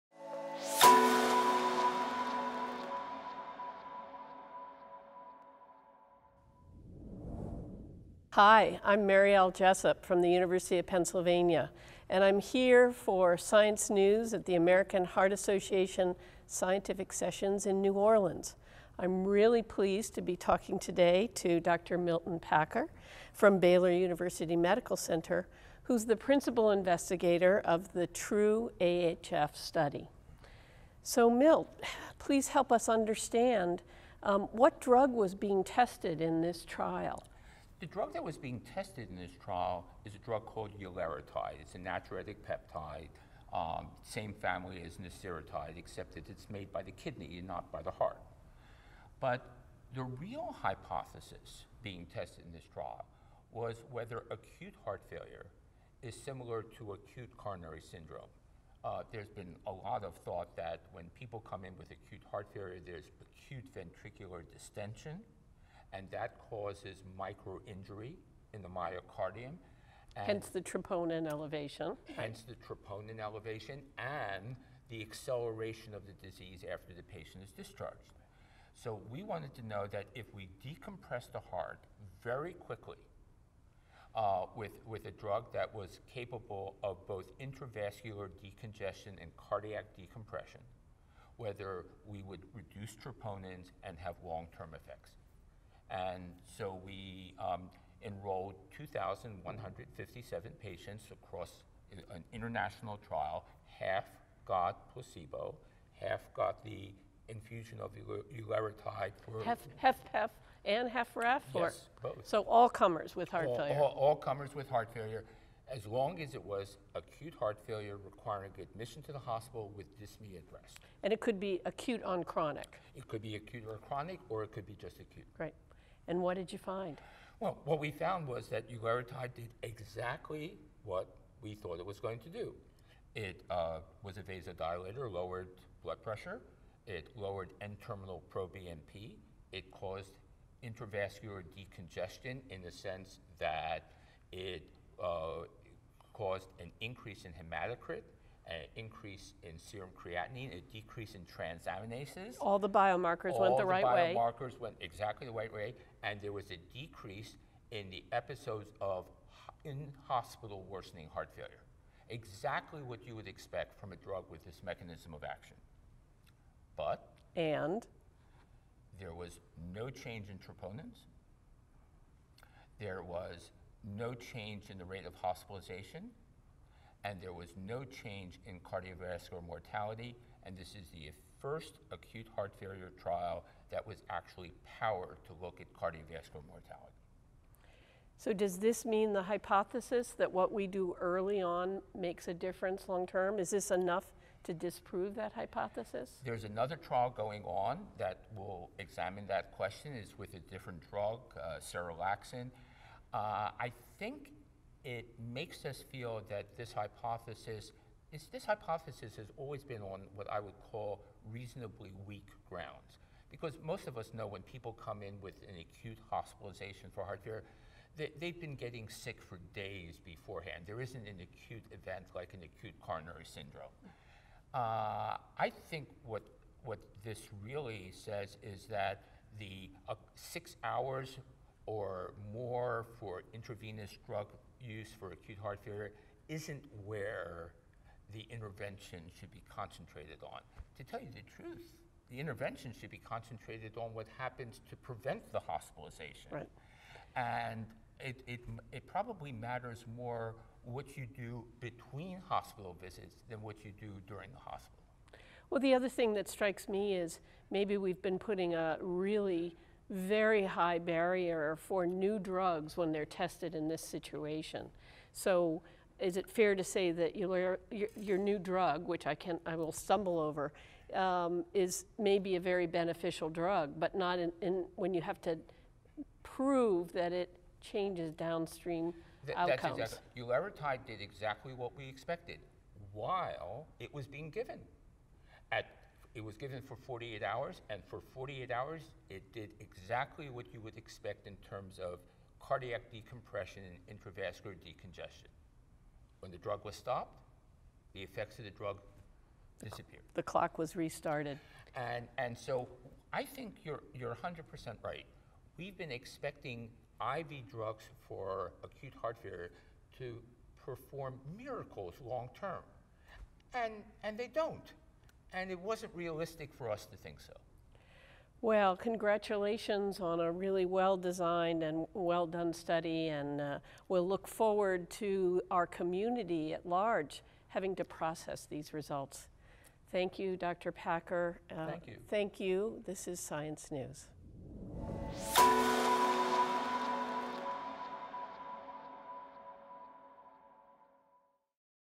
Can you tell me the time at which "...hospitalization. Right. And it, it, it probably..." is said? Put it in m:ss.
4:05.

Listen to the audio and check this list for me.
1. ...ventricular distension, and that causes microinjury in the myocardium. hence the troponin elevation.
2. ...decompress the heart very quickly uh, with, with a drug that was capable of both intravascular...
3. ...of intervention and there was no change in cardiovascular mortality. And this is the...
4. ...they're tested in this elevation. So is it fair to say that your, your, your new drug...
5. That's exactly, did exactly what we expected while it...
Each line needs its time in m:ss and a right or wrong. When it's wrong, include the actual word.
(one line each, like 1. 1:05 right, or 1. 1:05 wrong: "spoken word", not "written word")
1. 1:03 right
2. 1:20 right
3. 2:55 wrong: "hospitalization", not "intervention"
4. 4:22 wrong: "situation", not "elevation"
5. 4:39 right.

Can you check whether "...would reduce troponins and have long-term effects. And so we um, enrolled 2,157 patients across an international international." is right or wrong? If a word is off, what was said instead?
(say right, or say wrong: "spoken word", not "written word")
wrong: "trial", not "international".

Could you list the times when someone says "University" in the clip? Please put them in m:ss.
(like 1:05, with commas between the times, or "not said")
0:10, 0:23.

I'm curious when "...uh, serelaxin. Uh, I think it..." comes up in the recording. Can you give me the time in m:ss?
3:21.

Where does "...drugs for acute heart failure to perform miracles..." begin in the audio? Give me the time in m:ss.
5:07.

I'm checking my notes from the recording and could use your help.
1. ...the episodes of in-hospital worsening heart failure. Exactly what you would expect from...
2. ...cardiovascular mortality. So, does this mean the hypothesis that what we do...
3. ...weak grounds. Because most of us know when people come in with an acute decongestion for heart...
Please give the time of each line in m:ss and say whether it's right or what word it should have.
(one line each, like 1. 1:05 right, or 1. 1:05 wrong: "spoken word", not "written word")
1. 2:37 right
2. 3:05 right
3. 3:32 wrong: "hospitalization", not "decongestion".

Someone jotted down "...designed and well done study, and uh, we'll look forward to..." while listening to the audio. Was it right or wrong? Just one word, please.
right.